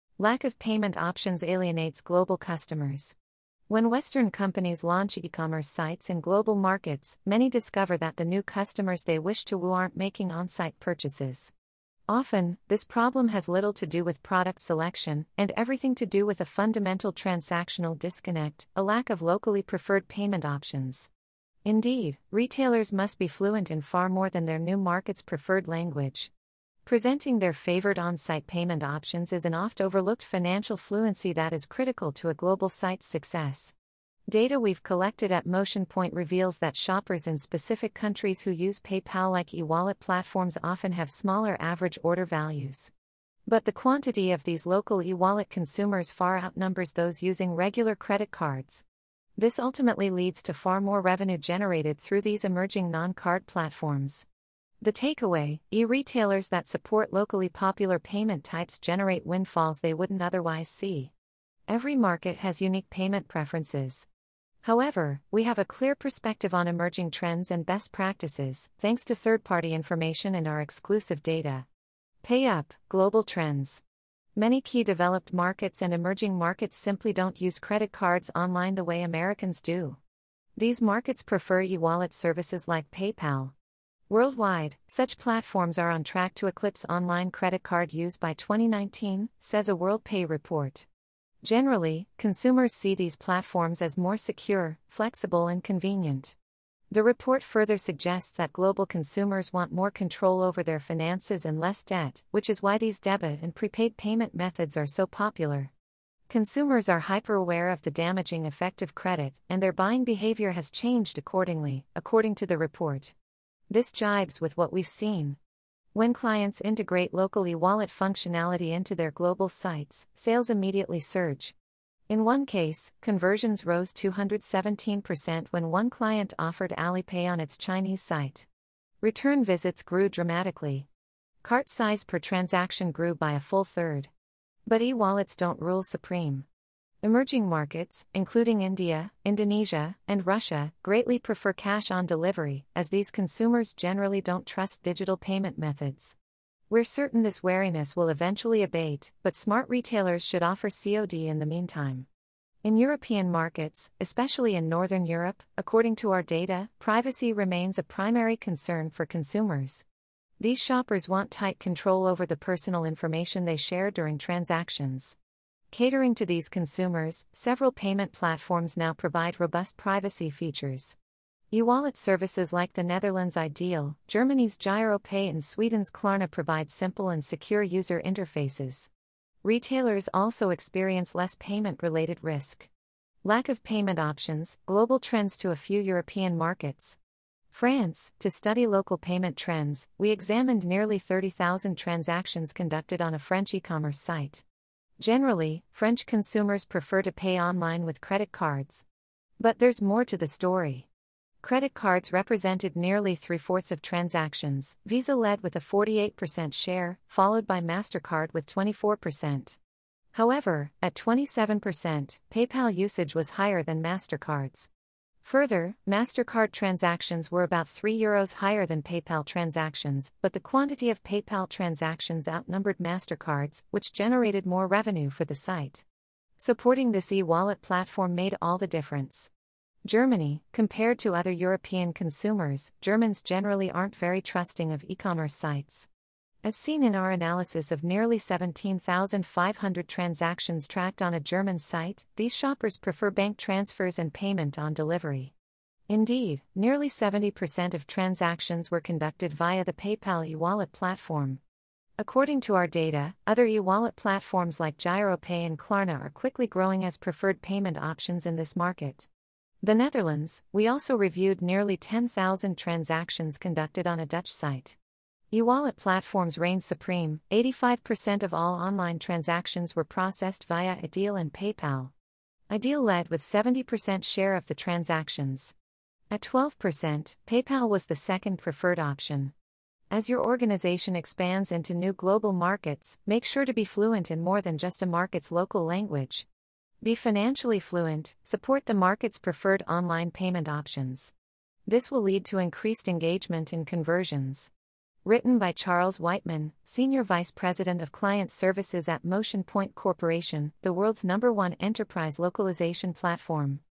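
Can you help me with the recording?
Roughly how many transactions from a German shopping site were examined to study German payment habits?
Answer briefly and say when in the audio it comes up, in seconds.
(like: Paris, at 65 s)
17,500, at 238 s.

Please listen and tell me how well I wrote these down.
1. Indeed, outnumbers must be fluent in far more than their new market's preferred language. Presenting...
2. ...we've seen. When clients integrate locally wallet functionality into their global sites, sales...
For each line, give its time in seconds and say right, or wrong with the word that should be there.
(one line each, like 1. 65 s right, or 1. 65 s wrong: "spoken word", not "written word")
1. 21 s wrong: "retailers", not "outnumbers"
2. 114 s right.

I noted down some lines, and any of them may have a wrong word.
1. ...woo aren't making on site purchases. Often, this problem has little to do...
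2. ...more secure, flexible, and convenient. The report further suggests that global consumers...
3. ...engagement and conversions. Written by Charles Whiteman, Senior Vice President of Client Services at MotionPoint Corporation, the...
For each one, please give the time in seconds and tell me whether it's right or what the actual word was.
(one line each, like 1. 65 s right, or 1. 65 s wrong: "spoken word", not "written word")
1. 9 s right
2. 93 s right
3. 292 s right.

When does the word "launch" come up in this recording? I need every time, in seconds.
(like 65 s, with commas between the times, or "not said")
4 s.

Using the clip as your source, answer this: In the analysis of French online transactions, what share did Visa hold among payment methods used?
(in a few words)
48%.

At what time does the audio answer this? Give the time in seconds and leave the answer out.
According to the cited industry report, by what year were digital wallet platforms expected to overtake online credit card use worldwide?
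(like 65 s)
88 s.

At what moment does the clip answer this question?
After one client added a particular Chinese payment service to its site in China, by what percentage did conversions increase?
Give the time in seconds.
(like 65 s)
123 s.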